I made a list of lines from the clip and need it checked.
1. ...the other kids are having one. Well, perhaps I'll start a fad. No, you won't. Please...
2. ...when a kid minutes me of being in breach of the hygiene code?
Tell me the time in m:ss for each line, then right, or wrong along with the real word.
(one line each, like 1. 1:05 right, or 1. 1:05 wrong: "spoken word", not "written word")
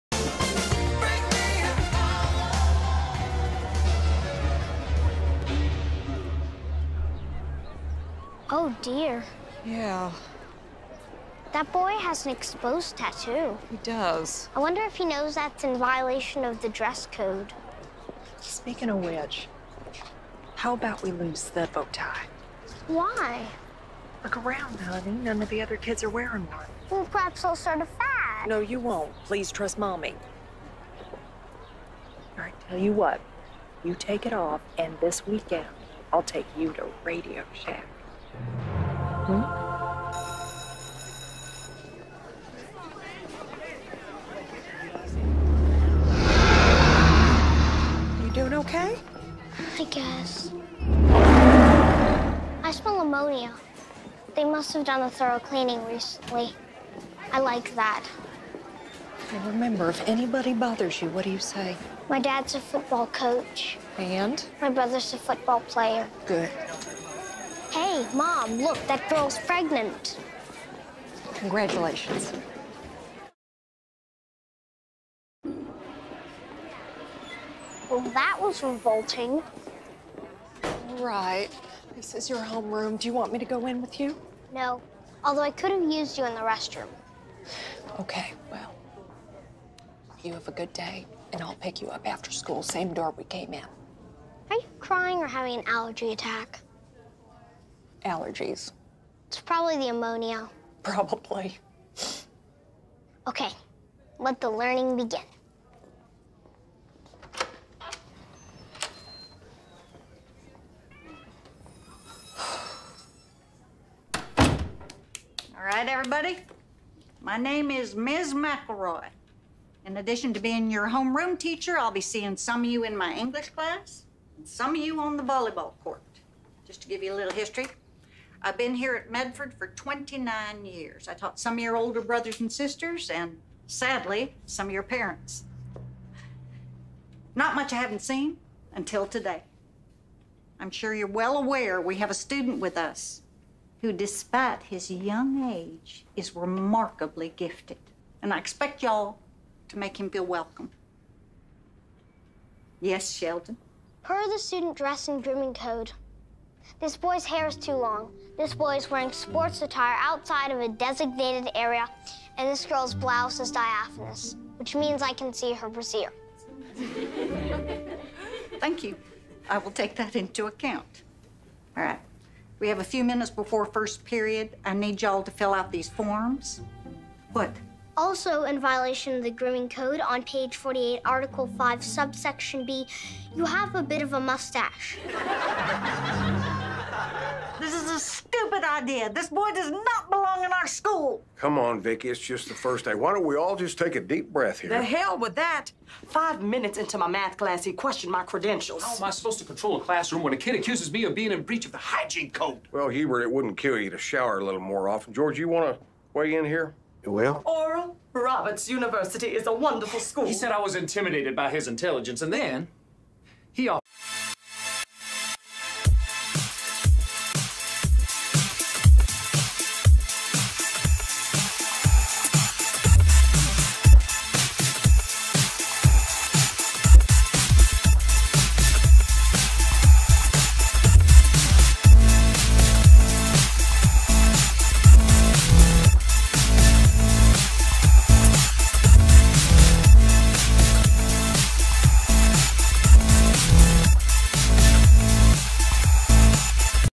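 1. 0:25 wrong: "wearing", not "having"
2. 3:20 wrong: "accuses", not "minutes".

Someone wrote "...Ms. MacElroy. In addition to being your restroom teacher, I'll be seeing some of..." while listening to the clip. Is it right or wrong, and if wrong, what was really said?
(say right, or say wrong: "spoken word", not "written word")
wrong: "homeroom", not "restroom".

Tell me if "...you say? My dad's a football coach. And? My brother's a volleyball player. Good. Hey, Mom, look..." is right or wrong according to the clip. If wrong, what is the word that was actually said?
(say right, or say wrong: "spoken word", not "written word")
wrong: "football", not "volleyball".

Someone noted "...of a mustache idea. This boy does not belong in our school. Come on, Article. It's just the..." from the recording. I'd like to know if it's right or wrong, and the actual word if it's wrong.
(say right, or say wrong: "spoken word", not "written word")
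wrong: "Vicky", not "Article".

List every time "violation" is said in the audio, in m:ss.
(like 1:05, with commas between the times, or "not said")
0:15, 2:58.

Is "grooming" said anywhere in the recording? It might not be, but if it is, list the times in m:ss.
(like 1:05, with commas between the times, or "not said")
2:35, 2:59.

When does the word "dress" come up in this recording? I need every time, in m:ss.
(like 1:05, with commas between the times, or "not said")
0:16, 2:34.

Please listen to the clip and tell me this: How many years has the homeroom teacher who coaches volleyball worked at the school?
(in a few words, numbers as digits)
29.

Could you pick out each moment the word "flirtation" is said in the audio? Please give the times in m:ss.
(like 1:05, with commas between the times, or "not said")
not said.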